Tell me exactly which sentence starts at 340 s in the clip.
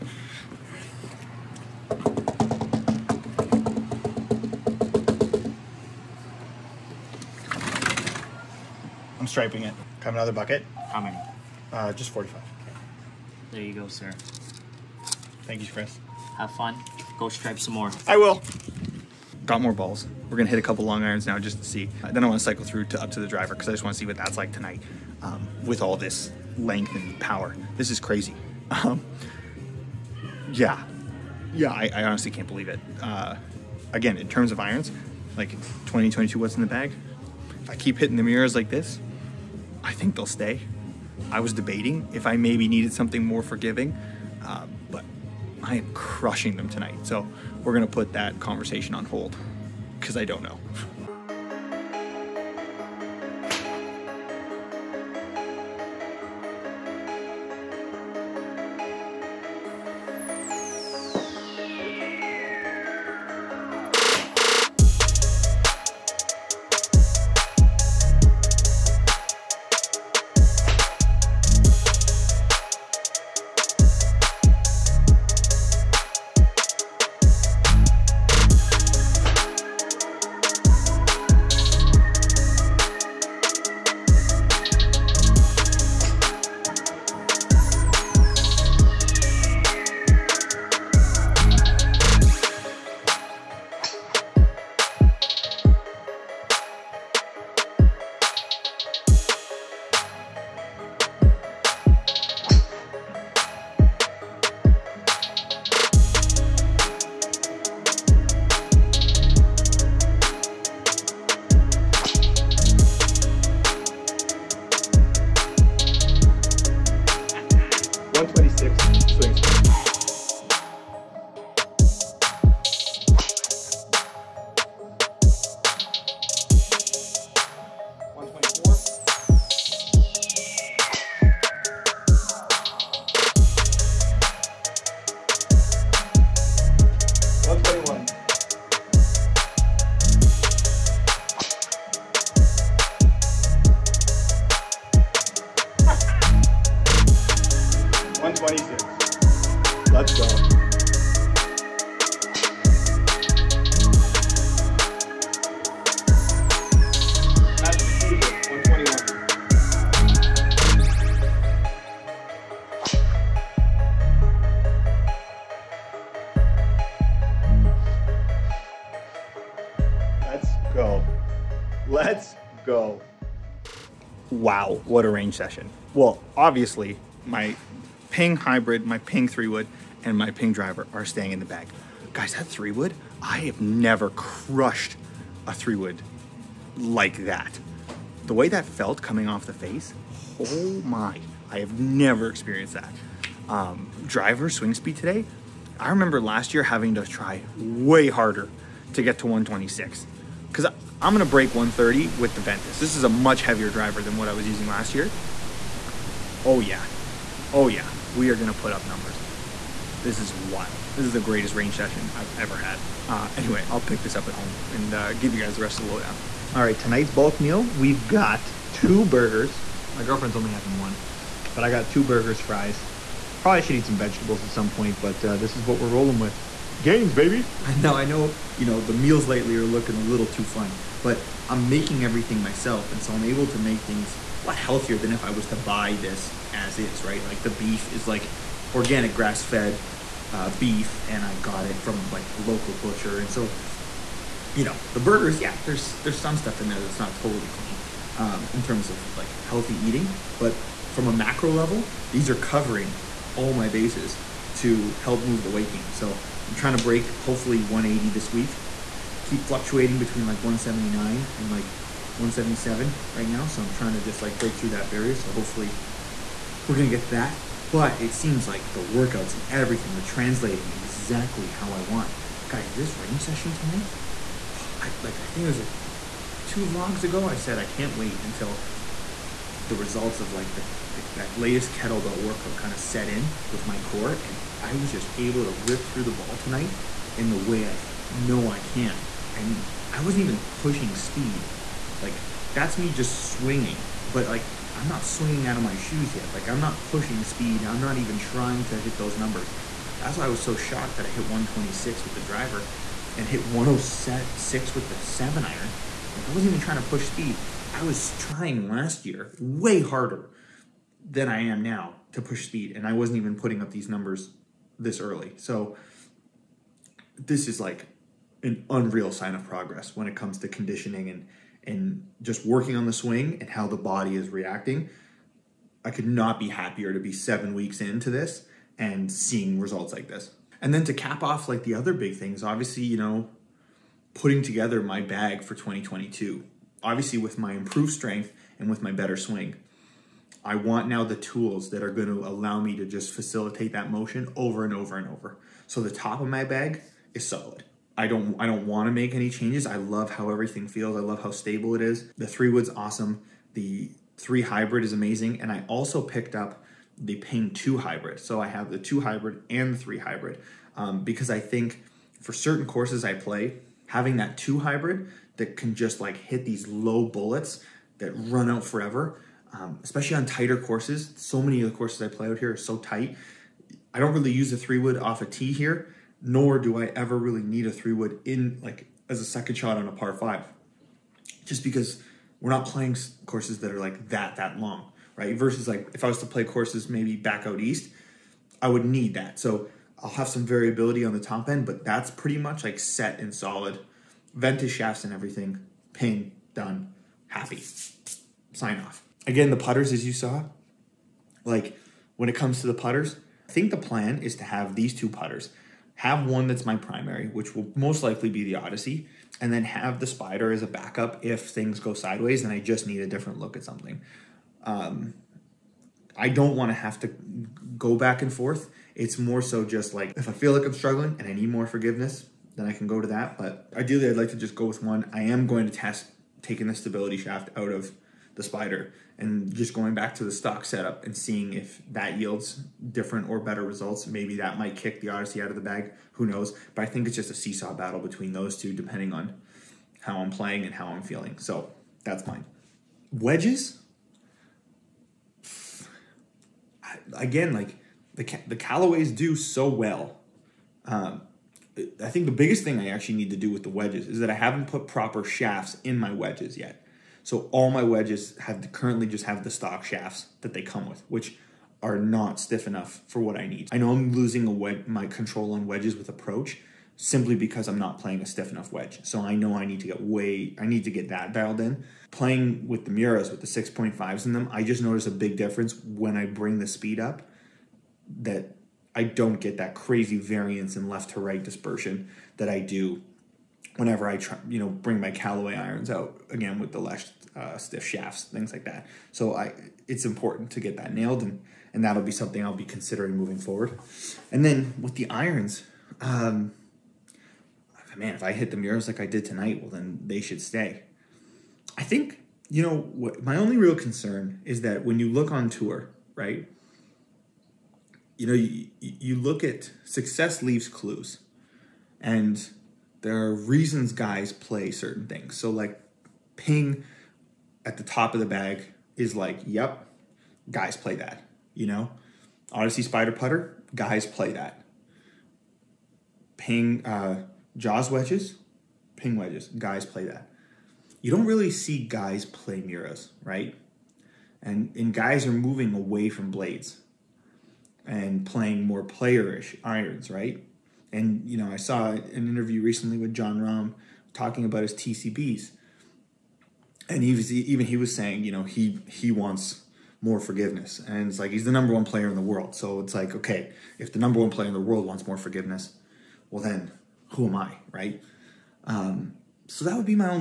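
I want now the tools that are going to allow me to just facilitate that motion over and over and over.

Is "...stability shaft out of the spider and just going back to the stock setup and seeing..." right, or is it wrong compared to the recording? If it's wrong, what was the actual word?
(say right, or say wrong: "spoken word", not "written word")
right.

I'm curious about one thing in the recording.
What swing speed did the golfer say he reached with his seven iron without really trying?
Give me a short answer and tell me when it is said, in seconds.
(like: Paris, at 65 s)
106, at 303 s.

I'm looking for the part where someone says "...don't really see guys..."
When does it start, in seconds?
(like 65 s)
531 s.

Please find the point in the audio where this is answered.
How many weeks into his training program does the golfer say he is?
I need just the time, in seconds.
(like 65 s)
327 s.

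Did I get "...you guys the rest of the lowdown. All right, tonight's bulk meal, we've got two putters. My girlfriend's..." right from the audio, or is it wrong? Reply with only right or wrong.
wrong.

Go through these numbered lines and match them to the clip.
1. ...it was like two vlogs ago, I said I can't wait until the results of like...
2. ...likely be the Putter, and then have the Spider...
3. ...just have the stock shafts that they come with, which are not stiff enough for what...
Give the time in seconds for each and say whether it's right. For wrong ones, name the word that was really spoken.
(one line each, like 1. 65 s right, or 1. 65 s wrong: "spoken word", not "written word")
1. 275 s right
2. 408 s wrong: "Odyssey", not "Putter"
3. 459 s right.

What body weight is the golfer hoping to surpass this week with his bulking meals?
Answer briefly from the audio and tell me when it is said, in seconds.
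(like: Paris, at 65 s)
180, at 256 s.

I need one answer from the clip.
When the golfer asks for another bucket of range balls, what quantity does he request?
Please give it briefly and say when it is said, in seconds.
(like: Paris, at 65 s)
45, at 11 s.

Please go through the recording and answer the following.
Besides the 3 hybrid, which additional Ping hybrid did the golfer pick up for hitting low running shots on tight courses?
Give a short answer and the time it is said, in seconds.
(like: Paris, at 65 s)
2 hybrid, at 357 s.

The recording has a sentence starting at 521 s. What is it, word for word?
You know, Odyssey Spider Putter, guys play that.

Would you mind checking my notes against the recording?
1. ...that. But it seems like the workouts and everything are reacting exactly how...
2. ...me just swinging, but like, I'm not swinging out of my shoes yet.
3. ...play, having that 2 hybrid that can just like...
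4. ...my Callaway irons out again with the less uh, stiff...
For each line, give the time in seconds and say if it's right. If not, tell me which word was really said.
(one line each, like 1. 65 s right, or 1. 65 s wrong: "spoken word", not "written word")
1. 267 s wrong: "translating", not "reacting"
2. 292 s right
3. 363 s right
4. 484 s right.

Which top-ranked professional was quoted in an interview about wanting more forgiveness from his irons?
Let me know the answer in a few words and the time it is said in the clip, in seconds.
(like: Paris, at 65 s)
Jon Rahm, at 543 s.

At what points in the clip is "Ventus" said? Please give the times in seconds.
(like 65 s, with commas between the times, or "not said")
202 s, 394 s.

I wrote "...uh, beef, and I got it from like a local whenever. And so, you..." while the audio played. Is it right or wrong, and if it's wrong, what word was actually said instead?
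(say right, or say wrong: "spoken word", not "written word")
wrong: "butcher", not "whenever".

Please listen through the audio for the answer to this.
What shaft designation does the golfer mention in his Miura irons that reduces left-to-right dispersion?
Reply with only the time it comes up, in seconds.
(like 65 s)
473 s.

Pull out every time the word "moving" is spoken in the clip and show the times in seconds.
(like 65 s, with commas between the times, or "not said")
493 s, 535 s.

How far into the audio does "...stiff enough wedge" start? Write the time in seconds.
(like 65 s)
468 s.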